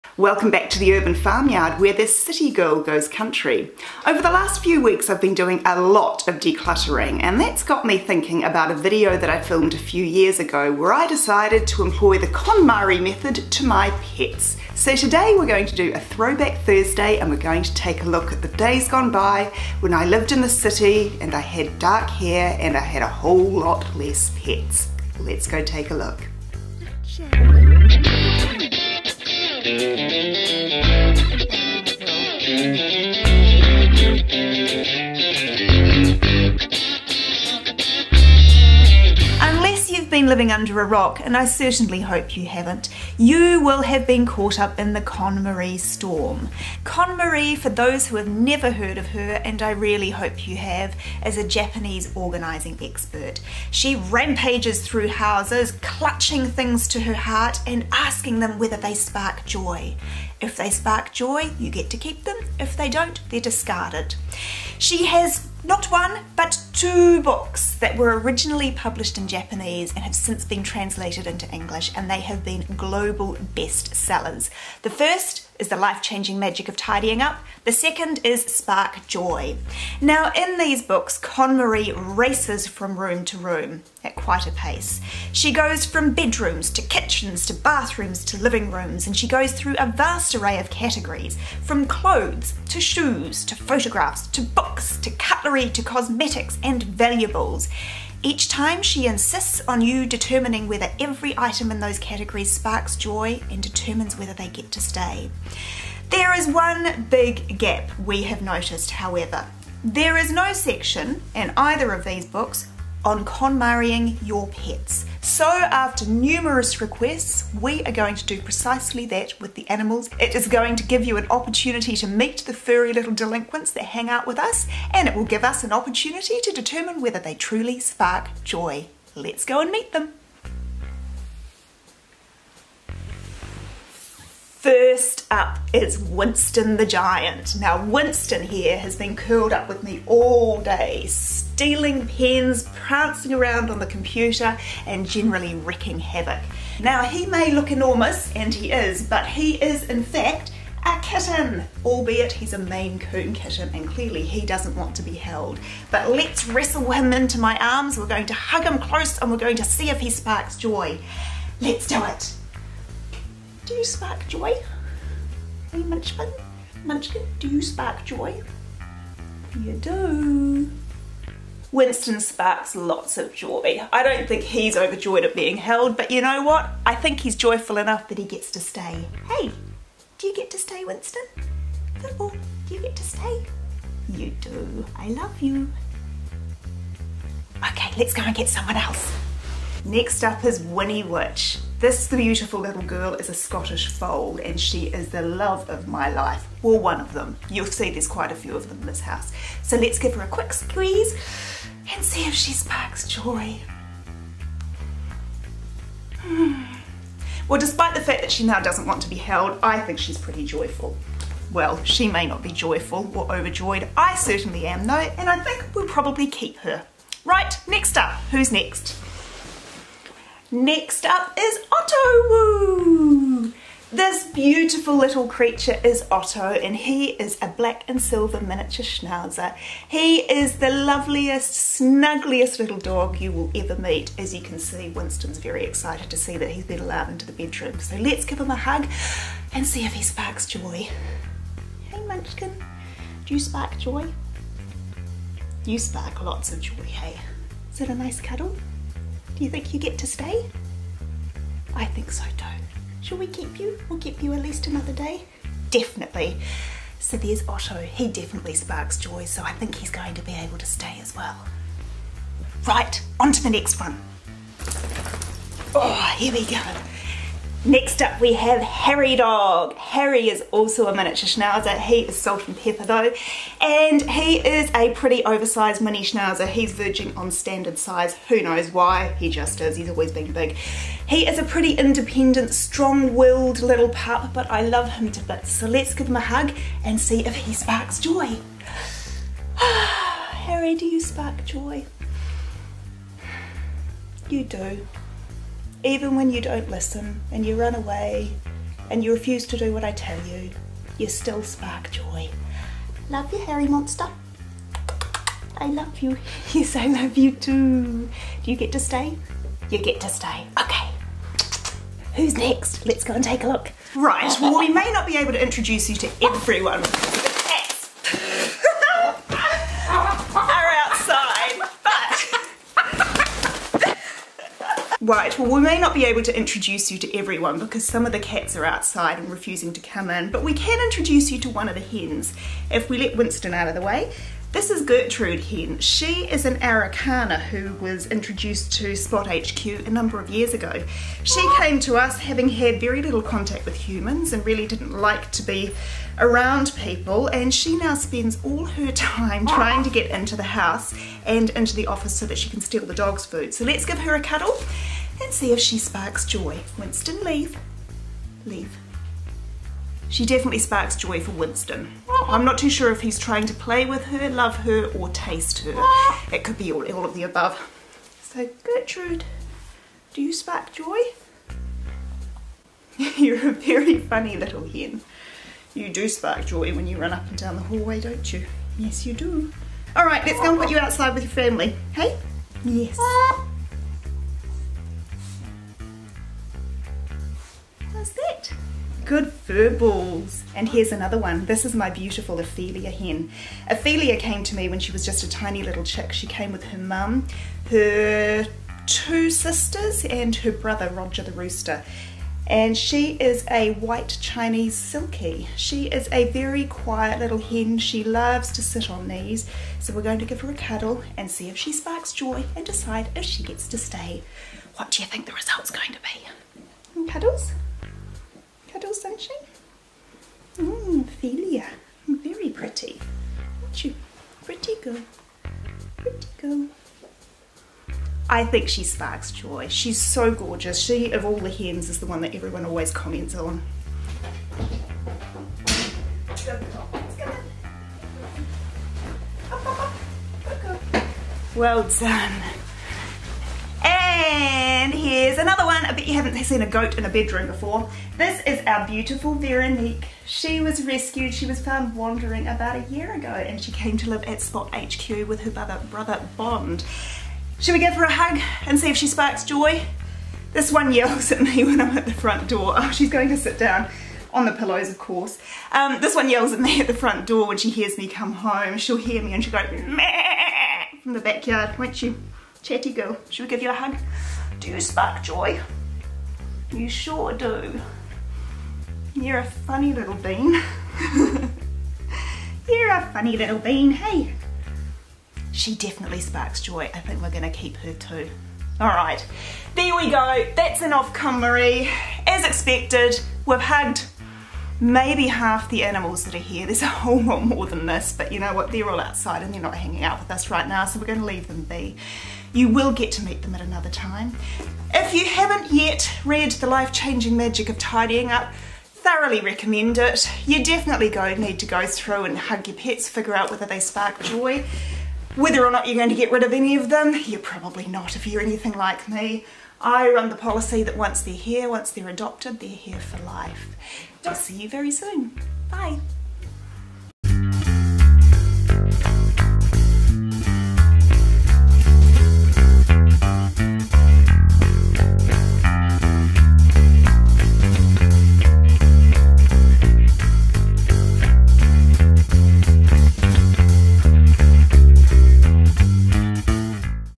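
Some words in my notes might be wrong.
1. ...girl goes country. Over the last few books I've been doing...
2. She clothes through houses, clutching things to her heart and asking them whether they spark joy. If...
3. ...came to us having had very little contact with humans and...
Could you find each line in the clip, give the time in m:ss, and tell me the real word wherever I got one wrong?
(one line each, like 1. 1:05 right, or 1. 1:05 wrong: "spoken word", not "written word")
1. 0:02 wrong: "weeks", not "books"
2. 0:53 wrong: "rampages", not "clothes"
3. 5:41 right.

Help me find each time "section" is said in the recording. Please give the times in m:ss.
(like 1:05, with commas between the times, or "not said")
1:50, 6:58.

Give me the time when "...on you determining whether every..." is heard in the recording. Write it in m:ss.
1:39.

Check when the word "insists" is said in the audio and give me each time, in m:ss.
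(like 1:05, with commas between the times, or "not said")
1:39.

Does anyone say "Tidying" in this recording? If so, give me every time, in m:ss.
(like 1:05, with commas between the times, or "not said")
1:16, 8:27.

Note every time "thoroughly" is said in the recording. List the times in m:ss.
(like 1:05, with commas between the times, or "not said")
8:28.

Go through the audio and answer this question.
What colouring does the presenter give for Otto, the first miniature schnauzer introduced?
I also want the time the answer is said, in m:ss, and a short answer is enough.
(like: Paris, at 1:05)
black and silver, at 3:47.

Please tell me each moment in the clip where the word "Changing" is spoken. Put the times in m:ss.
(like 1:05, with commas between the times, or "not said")
1:16, 8:26.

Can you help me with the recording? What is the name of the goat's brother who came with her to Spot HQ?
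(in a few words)
Bond.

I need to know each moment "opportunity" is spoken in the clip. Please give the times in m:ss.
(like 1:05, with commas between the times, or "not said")
2:01, 2:05.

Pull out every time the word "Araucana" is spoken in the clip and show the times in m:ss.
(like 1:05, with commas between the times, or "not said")
5:36.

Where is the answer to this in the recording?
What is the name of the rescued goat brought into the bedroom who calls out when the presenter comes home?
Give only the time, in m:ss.
7:29.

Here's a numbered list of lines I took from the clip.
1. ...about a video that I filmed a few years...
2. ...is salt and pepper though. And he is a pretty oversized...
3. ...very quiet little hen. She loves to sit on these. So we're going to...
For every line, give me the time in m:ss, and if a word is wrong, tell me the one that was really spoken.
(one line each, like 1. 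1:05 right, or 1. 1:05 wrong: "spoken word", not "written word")
1. 0:08 right
2. 4:31 right
3. 6:46 right.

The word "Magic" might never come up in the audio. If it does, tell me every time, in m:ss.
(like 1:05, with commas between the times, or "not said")
1:16, 8:27.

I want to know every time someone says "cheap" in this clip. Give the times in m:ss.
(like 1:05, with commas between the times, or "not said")
not said.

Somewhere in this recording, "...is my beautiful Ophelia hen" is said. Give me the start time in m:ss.
6:31.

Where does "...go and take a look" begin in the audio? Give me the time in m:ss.
5:13.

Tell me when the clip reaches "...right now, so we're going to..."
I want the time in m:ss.
8:20.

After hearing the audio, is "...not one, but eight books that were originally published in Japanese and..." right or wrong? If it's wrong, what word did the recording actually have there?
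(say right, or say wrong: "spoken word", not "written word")
wrong: "two", not "eight".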